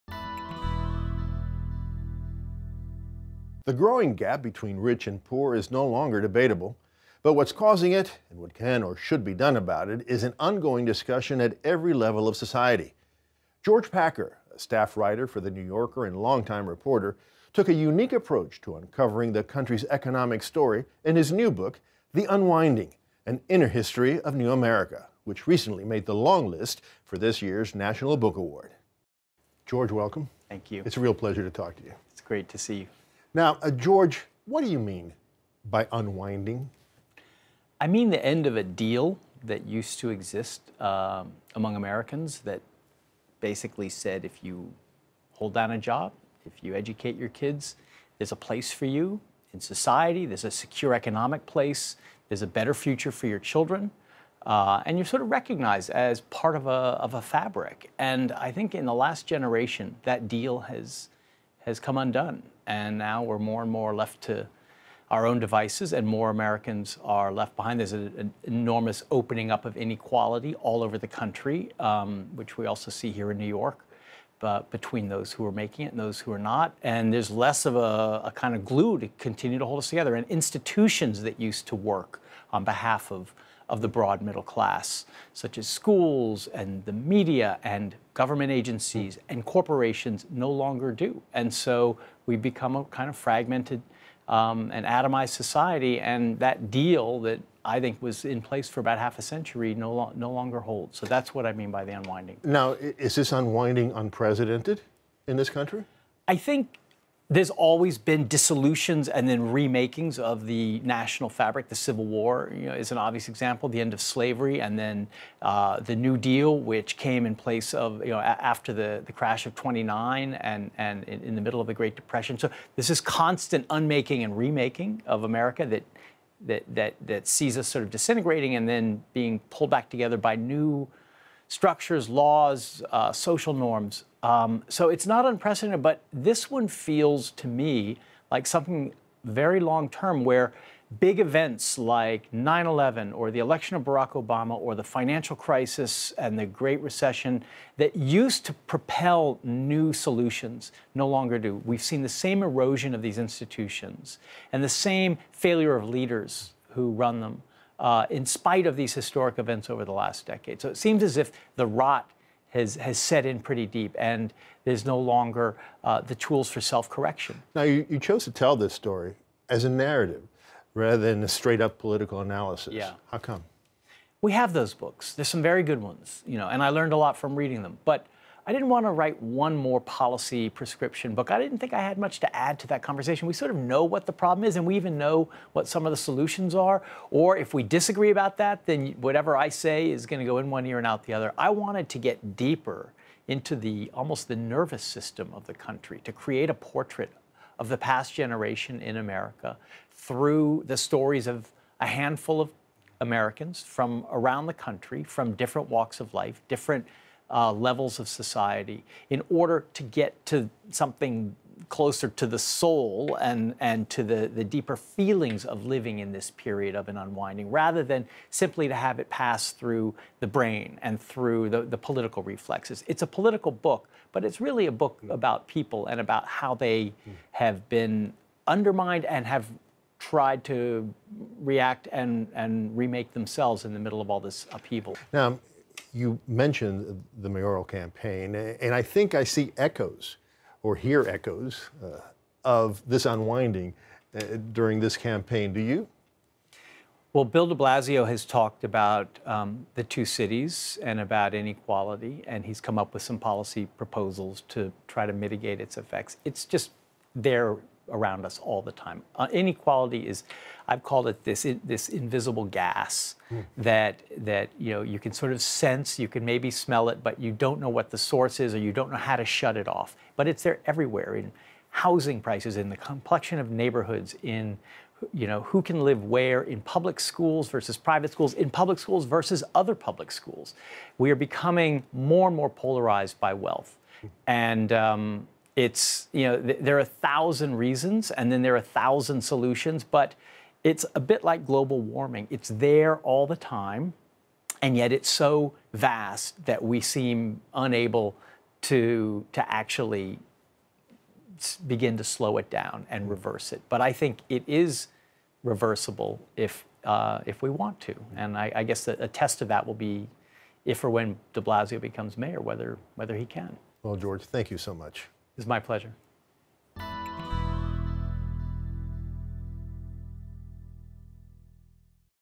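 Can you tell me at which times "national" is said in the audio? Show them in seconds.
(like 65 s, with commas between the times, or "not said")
27 s, 110 s.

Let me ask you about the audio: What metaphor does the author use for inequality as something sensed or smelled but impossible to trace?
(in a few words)
invisible gas.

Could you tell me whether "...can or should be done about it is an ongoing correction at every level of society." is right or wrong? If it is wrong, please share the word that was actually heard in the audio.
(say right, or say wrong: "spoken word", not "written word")
wrong: "discussion", not "correction".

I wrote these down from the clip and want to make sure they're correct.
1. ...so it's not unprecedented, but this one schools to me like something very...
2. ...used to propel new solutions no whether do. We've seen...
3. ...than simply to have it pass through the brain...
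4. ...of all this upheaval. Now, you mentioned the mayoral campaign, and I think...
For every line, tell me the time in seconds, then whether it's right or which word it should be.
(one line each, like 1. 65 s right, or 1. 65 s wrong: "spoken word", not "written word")
1. 134 s wrong: "feels", not "schools"
2. 147 s wrong: "longer", not "whether"
3. 217 s right
4. 234 s right.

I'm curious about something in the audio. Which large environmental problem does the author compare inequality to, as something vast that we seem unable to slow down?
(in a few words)
global warming.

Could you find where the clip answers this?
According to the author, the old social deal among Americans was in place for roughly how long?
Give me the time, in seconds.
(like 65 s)
98 s.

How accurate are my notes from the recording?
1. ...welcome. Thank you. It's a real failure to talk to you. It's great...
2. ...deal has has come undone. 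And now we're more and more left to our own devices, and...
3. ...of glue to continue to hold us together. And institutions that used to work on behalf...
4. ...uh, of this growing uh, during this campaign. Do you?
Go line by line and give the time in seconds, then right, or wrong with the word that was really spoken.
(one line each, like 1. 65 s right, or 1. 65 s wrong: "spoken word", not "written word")
1. 29 s wrong: "pleasure", not "failure"
2. 60 s right
3. 78 s right
4. 241 s wrong: "unwinding", not "growing".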